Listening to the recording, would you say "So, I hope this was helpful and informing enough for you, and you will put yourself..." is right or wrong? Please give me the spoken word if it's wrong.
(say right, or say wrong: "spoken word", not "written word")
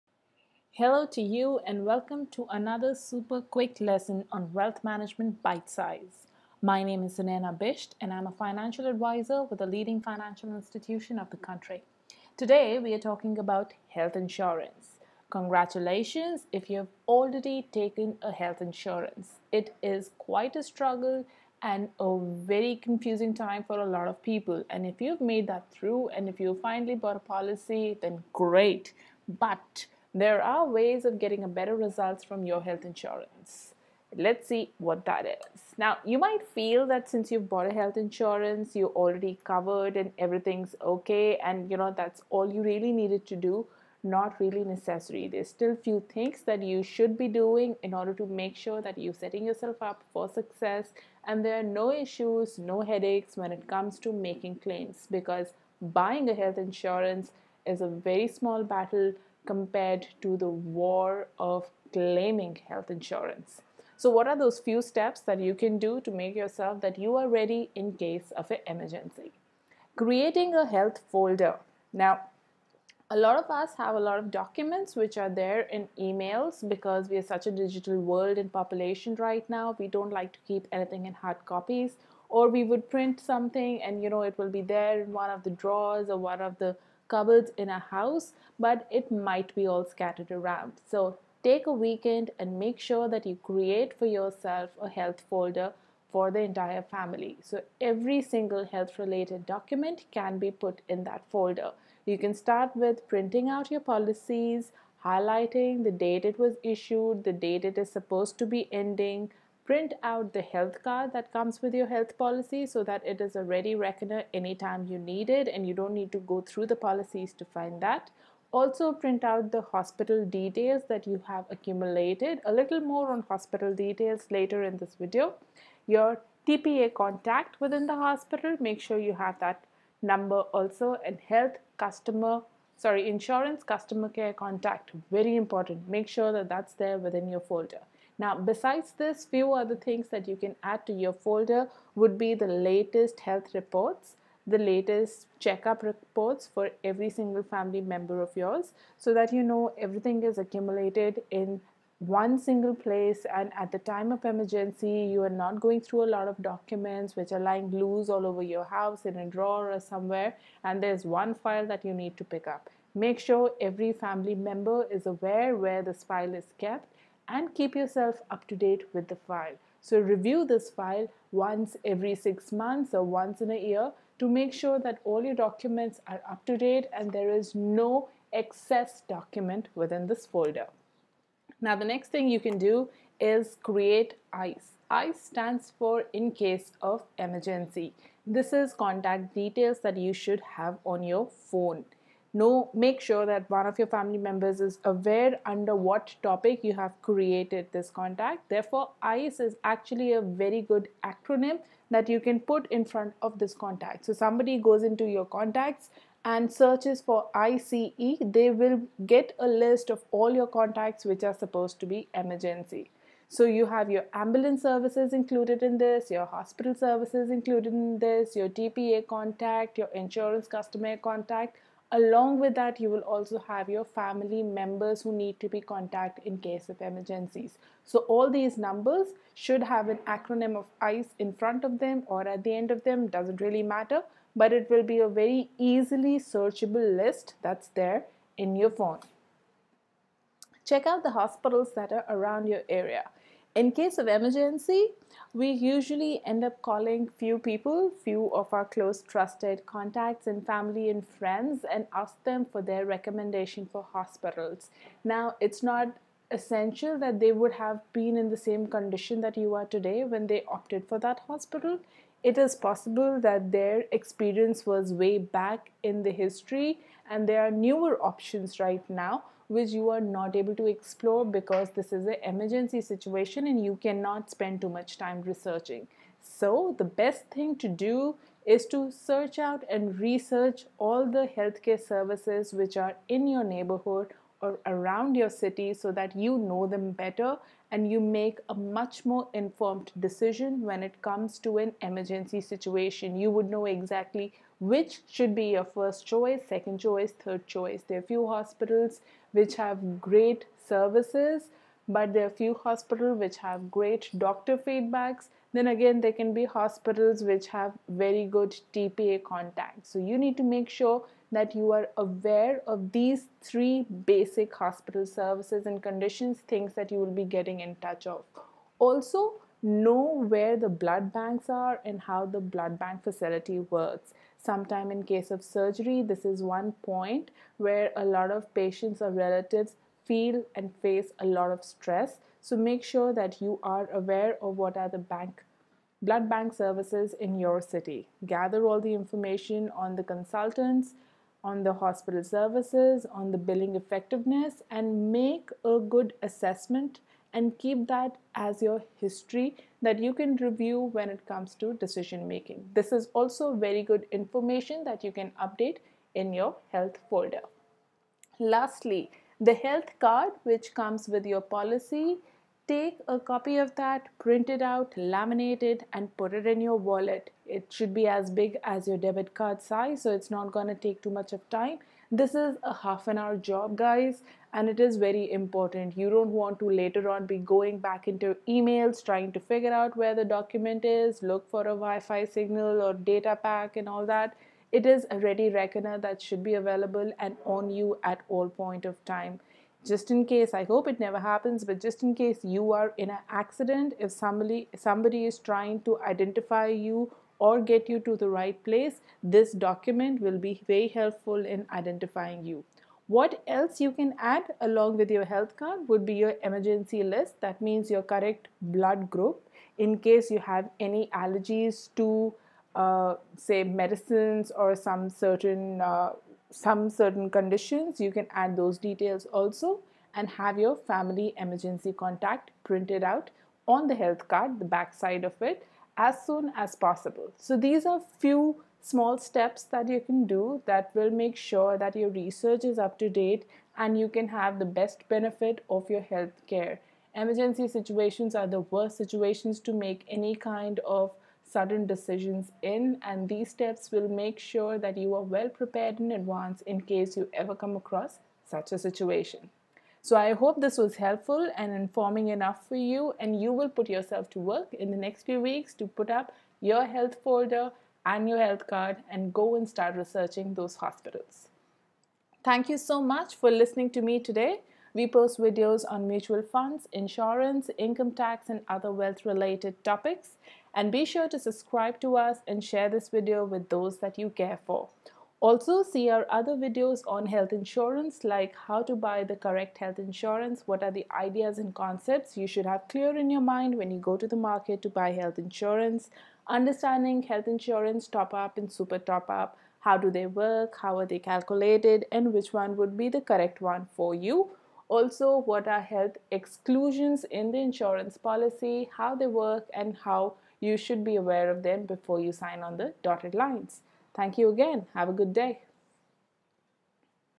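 right.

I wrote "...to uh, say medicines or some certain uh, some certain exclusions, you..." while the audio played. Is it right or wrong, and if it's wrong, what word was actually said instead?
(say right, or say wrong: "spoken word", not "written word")
wrong: "conditions", not "exclusions".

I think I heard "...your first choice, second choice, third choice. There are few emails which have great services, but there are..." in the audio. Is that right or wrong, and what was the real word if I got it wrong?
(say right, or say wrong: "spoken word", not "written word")
wrong: "hospitals", not "emails".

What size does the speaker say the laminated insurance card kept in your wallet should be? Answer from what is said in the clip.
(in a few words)
debit card size.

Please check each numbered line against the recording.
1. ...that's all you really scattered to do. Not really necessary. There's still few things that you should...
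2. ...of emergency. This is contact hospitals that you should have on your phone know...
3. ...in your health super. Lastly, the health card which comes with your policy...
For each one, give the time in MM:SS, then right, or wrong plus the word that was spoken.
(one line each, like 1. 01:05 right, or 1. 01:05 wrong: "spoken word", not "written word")
1. 00:41 wrong: "needed", not "scattered"
2. 03:06 wrong: "details", not "hospitals"
3. 05:56 wrong: "folder", not "super".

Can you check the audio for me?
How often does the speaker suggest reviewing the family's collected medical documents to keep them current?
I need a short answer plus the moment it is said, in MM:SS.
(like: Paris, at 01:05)
every six months, at 02:51.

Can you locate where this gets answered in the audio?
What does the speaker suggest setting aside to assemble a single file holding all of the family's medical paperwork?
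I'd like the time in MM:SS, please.
01:31.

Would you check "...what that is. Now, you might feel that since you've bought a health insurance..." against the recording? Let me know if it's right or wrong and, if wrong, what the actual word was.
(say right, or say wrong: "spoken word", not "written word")
right.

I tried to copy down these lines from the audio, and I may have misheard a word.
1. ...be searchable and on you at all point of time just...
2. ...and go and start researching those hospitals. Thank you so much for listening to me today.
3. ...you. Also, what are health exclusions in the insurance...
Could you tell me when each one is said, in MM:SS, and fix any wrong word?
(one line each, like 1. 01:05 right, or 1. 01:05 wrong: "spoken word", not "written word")
1. 06:26 wrong: "available", not "searchable"
2. 07:39 right
3. 08:14 right.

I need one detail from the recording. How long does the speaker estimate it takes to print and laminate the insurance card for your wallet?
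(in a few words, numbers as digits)
half an hour.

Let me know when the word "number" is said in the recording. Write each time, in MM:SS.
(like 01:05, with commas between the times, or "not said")
02:10, 03:48.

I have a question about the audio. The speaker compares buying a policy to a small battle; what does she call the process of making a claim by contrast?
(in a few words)
the war.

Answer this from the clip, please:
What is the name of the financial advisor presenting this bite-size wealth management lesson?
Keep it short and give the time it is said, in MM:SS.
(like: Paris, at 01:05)
Sunaina Bisht, at 00:07.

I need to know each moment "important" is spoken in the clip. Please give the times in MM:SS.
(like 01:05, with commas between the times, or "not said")
02:15, 06:15.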